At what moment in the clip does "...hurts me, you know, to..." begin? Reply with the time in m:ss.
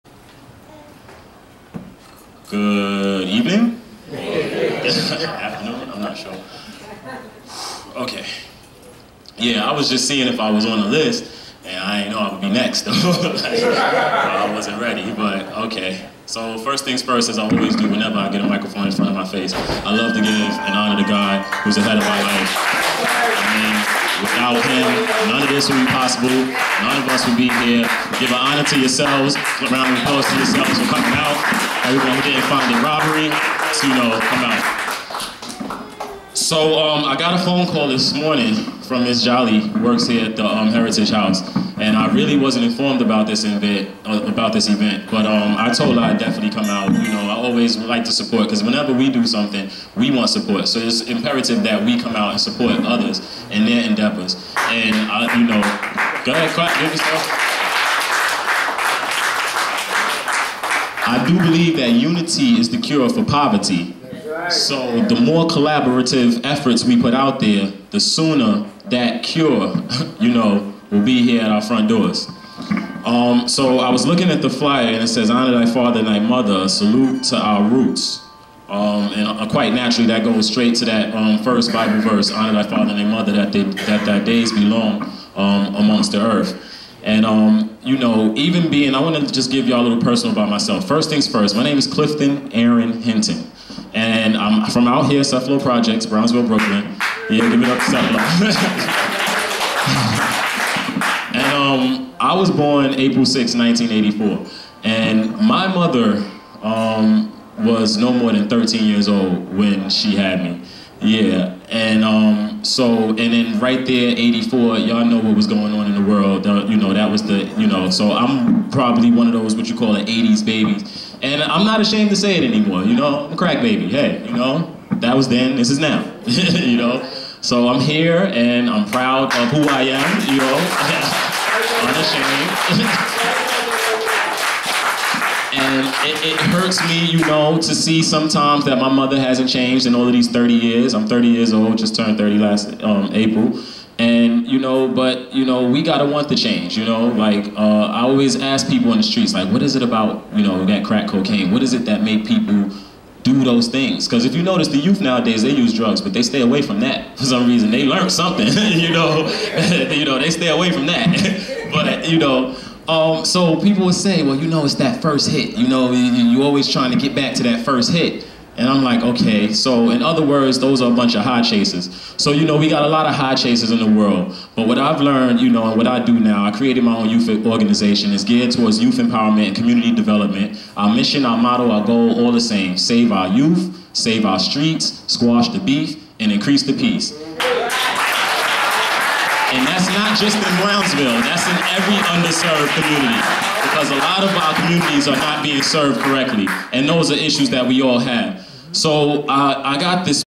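2:16.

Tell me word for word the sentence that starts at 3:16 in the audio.
And those are issues that we all have.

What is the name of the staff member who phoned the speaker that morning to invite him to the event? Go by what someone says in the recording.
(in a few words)
Miss Jolly.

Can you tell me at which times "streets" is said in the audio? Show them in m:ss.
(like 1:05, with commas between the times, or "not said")
2:29, 3:04.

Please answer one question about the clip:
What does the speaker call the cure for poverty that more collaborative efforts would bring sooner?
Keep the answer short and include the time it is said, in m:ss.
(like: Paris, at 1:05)
Unity, at 1:01.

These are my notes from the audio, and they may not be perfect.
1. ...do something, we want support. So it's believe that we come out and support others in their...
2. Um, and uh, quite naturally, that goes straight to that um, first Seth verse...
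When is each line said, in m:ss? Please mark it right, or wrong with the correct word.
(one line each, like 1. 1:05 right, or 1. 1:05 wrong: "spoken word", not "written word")
1. 0:49 wrong: "imperative", not "believe"
2. 1:18 wrong: "Bible", not "Seth".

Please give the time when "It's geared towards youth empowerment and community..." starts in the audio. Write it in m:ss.
2:58.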